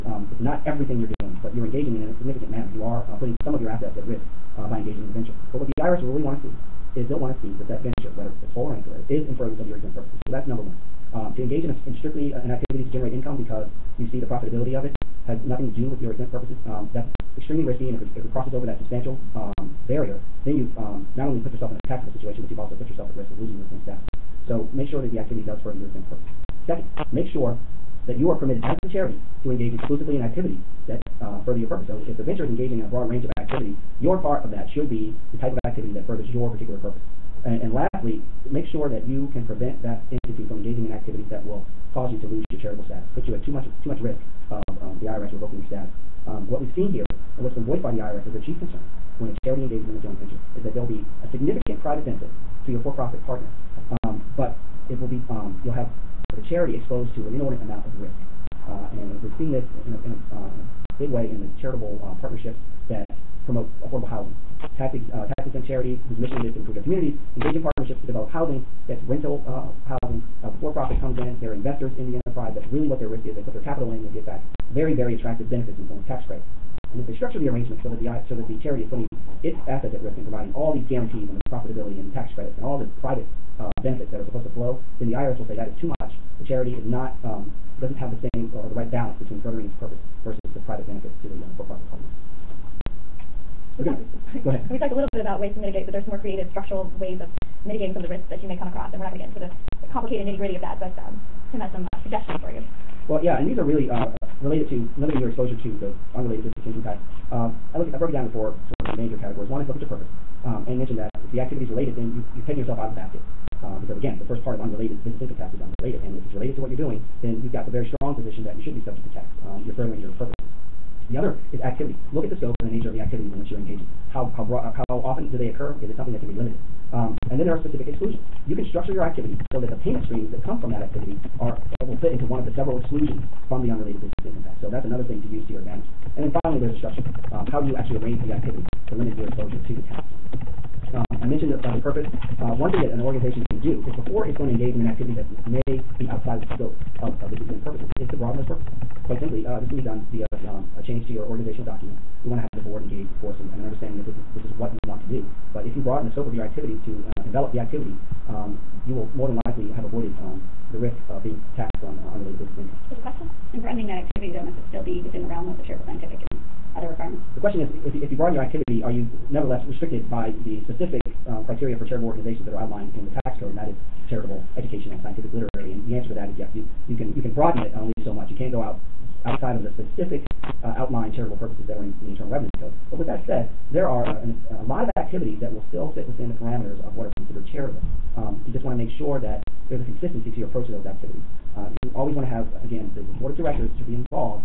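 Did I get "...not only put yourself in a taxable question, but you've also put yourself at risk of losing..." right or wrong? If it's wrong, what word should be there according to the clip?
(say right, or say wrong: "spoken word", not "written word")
wrong: "situation", not "question".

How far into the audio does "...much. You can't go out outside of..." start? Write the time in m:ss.
2:58.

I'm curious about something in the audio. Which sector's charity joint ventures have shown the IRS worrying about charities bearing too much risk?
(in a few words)
Affordable housing.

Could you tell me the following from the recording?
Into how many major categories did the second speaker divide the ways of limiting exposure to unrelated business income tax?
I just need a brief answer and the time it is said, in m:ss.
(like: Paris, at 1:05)
4, at 1:48.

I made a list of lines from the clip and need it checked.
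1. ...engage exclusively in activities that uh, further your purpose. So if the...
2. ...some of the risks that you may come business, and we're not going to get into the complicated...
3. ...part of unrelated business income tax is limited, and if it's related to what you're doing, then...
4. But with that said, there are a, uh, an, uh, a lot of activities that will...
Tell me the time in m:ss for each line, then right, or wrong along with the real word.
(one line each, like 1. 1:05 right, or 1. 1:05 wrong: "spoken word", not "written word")
1. 0:29 right
2. 1:37 wrong: "across", not "business"
3. 1:54 wrong: "unrelated", not "limited"
4. 3:02 right.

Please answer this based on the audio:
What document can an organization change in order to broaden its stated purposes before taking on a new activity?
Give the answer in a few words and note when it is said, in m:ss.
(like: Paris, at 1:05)
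Organizational document, at 2:31.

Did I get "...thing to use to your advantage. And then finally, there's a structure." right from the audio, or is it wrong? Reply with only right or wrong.
right.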